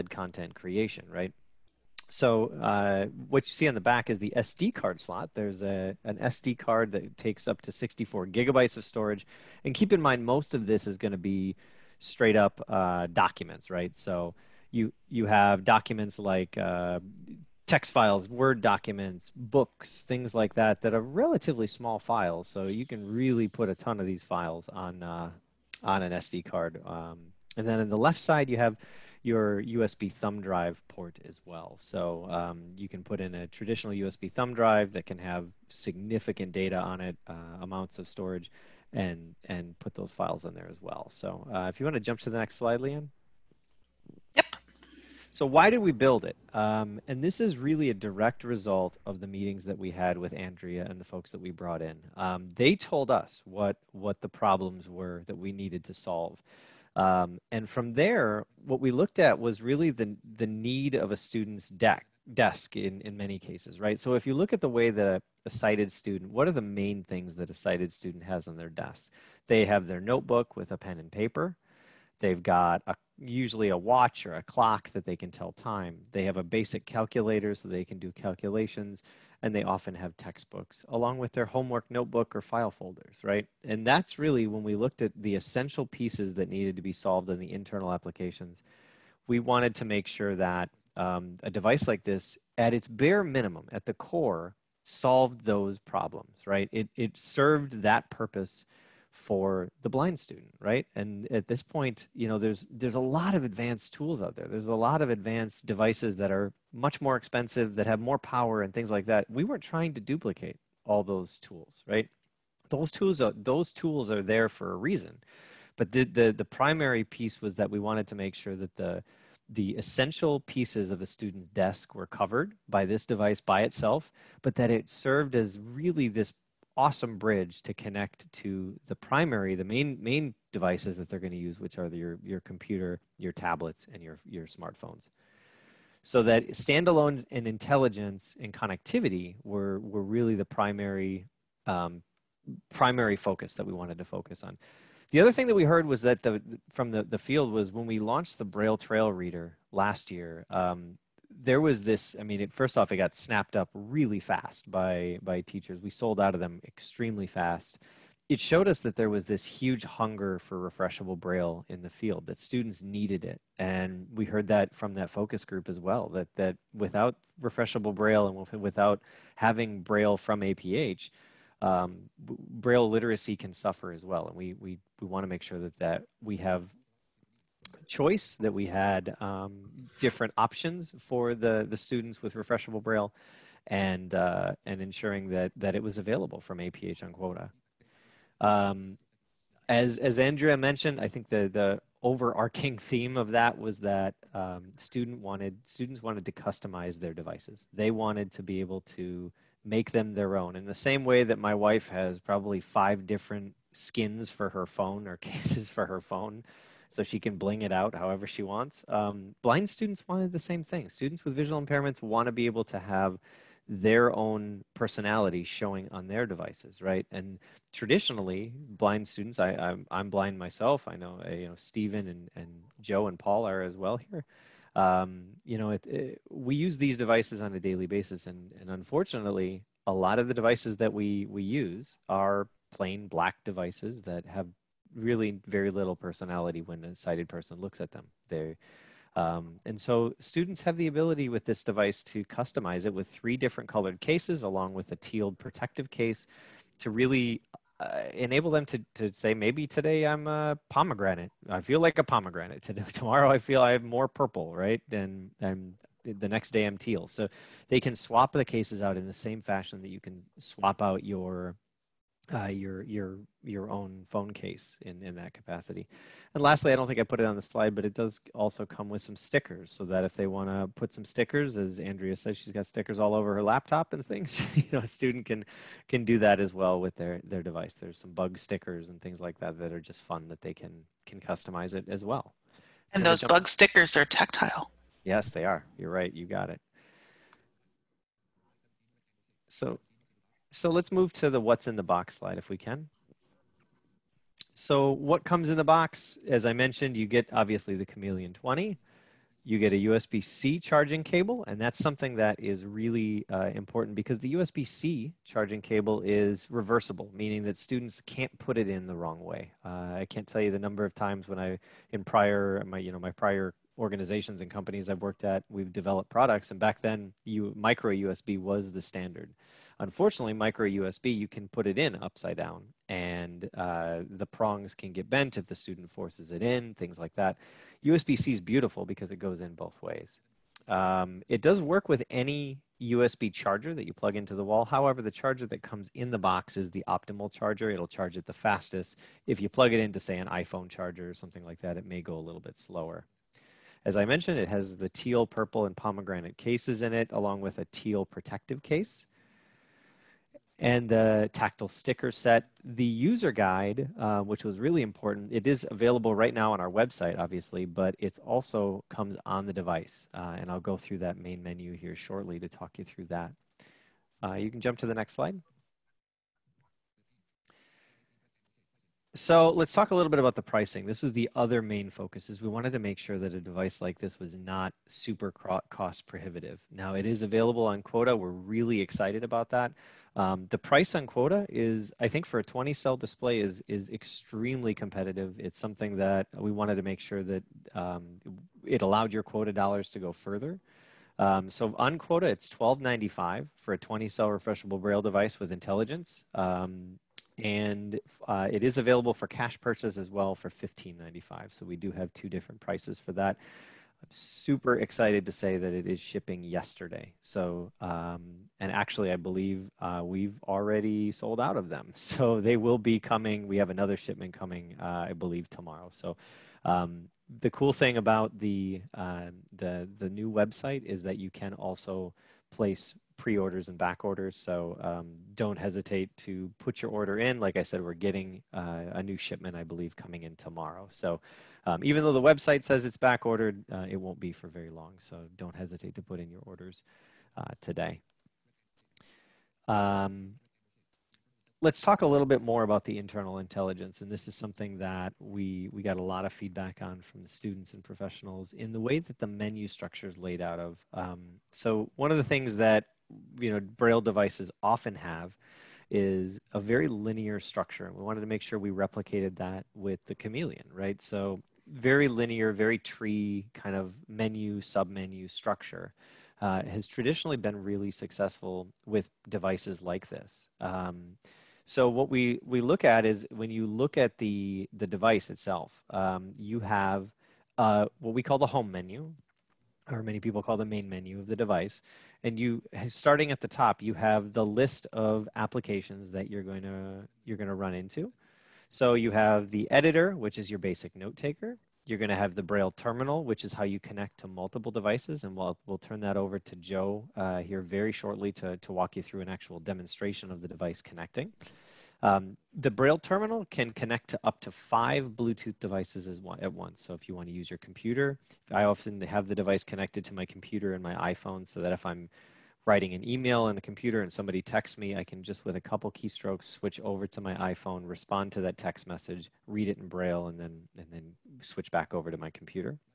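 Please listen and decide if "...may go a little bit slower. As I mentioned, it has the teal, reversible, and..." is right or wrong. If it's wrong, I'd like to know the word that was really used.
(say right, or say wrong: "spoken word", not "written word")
wrong: "purple", not "reversible".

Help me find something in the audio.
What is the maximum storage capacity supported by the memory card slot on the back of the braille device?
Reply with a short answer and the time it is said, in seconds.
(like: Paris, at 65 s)
64 gigabytes, at 7 s.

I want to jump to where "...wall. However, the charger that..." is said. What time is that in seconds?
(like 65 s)
334 s.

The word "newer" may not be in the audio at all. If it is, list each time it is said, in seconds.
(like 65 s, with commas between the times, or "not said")
not said.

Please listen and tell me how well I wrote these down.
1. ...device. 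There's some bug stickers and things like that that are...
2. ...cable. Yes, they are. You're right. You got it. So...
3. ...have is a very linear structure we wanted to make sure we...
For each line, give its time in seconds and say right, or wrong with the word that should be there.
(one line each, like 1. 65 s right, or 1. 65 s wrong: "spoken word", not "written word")
1. 277 s right
2. 284 s wrong: "tactile", not "cable"
3. 454 s right.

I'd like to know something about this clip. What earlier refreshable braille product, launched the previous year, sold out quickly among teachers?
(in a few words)
Braille Trail Reader.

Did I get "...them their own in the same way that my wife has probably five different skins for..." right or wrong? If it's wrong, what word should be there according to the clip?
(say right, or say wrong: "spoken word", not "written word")
right.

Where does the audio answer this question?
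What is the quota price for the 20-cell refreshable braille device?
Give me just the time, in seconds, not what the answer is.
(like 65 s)
392 s.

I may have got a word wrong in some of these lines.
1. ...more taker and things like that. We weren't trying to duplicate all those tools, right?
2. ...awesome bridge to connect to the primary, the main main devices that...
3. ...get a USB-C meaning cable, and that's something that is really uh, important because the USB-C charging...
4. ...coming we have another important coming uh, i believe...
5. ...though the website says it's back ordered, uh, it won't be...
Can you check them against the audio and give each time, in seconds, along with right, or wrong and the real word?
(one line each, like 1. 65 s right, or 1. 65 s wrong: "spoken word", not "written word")
1. 107 s wrong: "power", not "taker"
2. 126 s right
3. 299 s wrong: "charging", not "meaning"
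4. 412 s wrong: "shipment", not "important"
5. 432 s right.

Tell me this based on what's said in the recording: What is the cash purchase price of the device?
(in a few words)
$15.95.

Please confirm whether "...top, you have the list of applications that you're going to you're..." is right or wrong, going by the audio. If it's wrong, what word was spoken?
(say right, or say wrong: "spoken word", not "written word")
right.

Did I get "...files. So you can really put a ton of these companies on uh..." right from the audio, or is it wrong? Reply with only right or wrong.
wrong.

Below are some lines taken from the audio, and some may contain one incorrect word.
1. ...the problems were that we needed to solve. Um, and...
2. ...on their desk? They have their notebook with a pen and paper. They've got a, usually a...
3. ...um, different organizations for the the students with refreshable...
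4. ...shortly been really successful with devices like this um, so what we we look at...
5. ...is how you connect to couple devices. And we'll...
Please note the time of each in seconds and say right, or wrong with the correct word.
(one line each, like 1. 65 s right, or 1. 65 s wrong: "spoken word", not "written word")
1. 54 s right
2. 68 s right
3. 179 s wrong: "options", not "organizations"
4. 466 s wrong: "traditionally", not "shortly"
5. 493 s wrong: "multiple", not "couple".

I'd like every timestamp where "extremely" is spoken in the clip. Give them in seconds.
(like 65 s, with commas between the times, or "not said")
156 s, 383 s.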